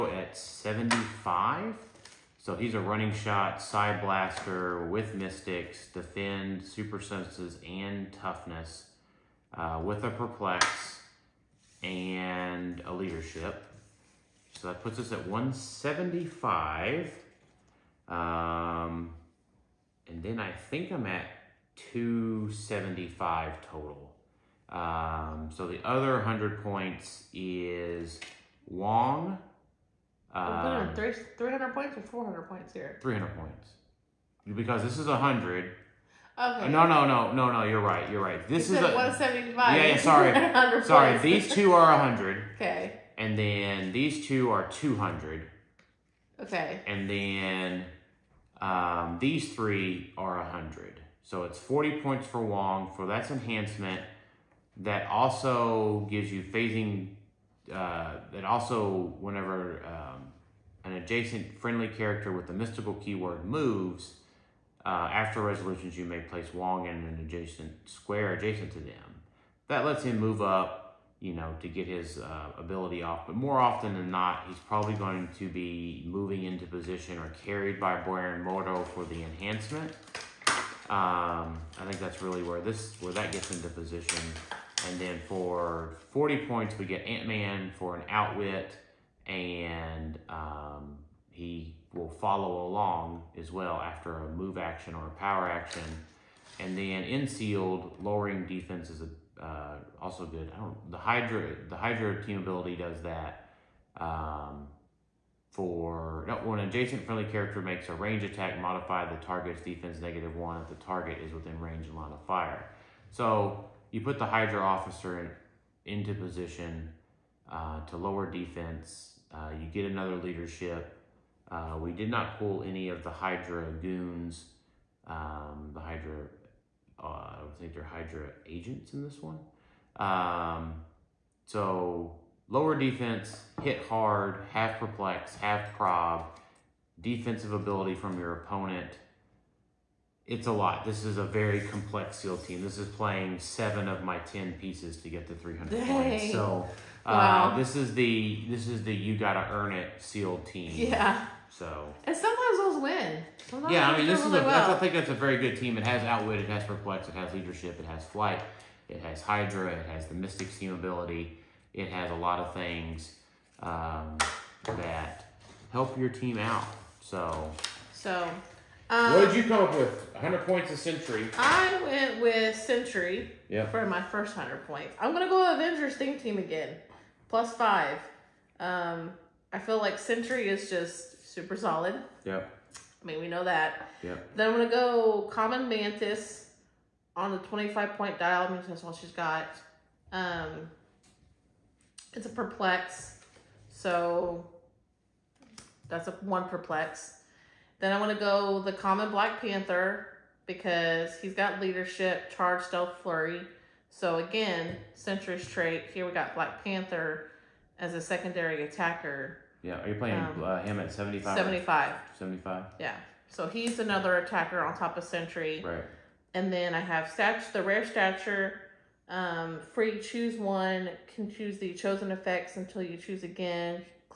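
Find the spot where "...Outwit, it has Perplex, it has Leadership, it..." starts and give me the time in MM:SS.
02:36.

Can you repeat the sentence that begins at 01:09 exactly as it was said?
That lets him move up you know, to get his uh, ability off.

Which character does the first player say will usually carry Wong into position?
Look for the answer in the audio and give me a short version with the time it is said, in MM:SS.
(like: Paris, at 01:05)
Baron Mordo, at 01:18.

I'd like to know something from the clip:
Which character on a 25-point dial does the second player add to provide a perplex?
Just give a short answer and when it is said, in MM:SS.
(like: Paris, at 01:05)
Mantis, at 03:05.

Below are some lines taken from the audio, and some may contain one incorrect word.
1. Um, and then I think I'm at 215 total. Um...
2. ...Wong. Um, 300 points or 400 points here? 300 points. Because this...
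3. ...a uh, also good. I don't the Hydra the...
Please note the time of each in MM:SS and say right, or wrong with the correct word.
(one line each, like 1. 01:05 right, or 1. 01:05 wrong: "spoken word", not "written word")
1. 00:18 wrong: "275", not "215"
2. 00:28 right
3. 01:39 right.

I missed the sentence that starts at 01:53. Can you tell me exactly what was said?
So you put the Hydra officer in, into position uh, to lower defense.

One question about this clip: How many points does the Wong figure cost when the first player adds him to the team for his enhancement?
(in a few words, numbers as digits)
40.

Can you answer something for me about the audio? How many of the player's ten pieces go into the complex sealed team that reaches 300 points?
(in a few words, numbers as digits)
7.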